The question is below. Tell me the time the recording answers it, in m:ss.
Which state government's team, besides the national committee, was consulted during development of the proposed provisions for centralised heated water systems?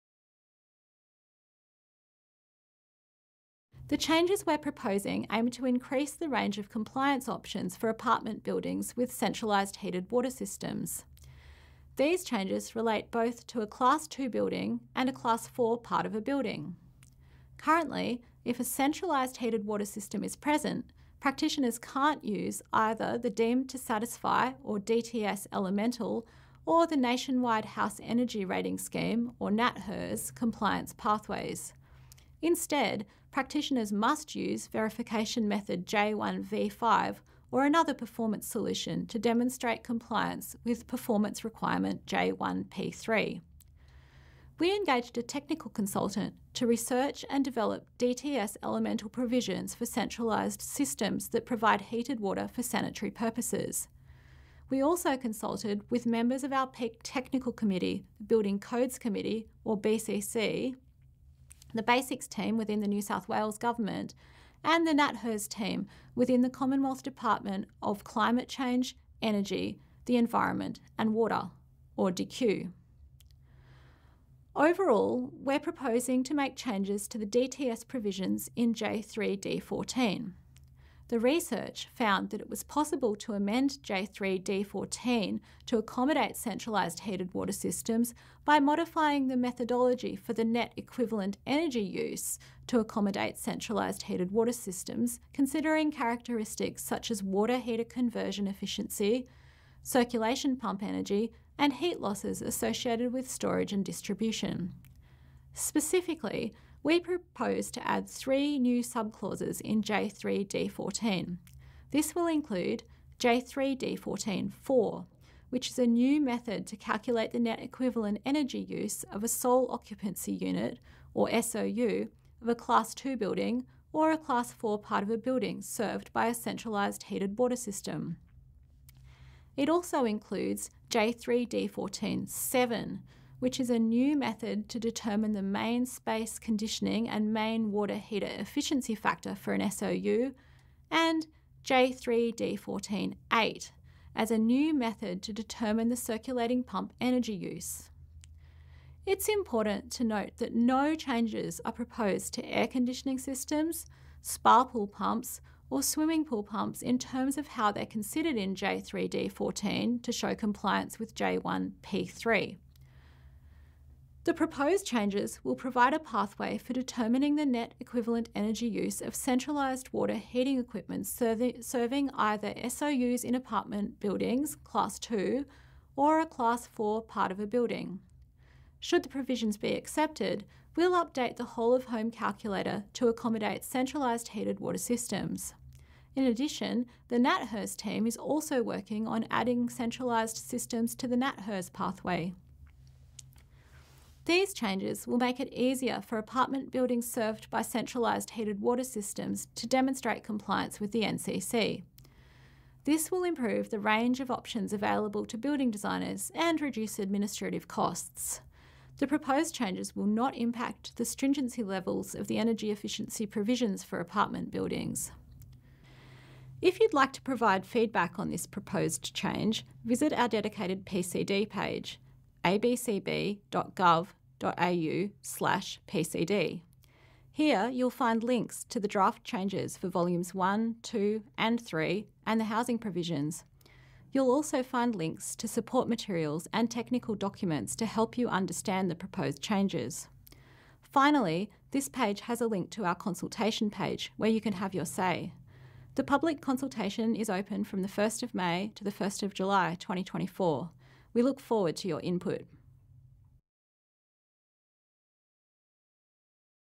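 1:02.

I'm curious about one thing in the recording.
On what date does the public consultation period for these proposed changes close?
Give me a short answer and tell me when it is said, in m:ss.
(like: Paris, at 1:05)
1 July 2024, at 4:08.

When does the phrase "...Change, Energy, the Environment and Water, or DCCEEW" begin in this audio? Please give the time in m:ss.
1:08.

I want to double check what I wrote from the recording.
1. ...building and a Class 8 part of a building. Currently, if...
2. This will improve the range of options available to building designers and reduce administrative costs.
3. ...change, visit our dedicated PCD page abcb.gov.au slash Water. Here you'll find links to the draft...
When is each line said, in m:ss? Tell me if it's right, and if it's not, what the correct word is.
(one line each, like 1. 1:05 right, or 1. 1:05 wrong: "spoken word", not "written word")
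1. 0:14 wrong: "4", not "8"
2. 3:22 right
3. 3:39 wrong: "PCD", not "Water".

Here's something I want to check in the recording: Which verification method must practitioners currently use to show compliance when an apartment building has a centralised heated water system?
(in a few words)
J1V5.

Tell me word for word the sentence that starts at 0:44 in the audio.
We engaged a technical consultant to research and develop DTS elemental provisions for centralised systems that provide heated water for sanitary purposes.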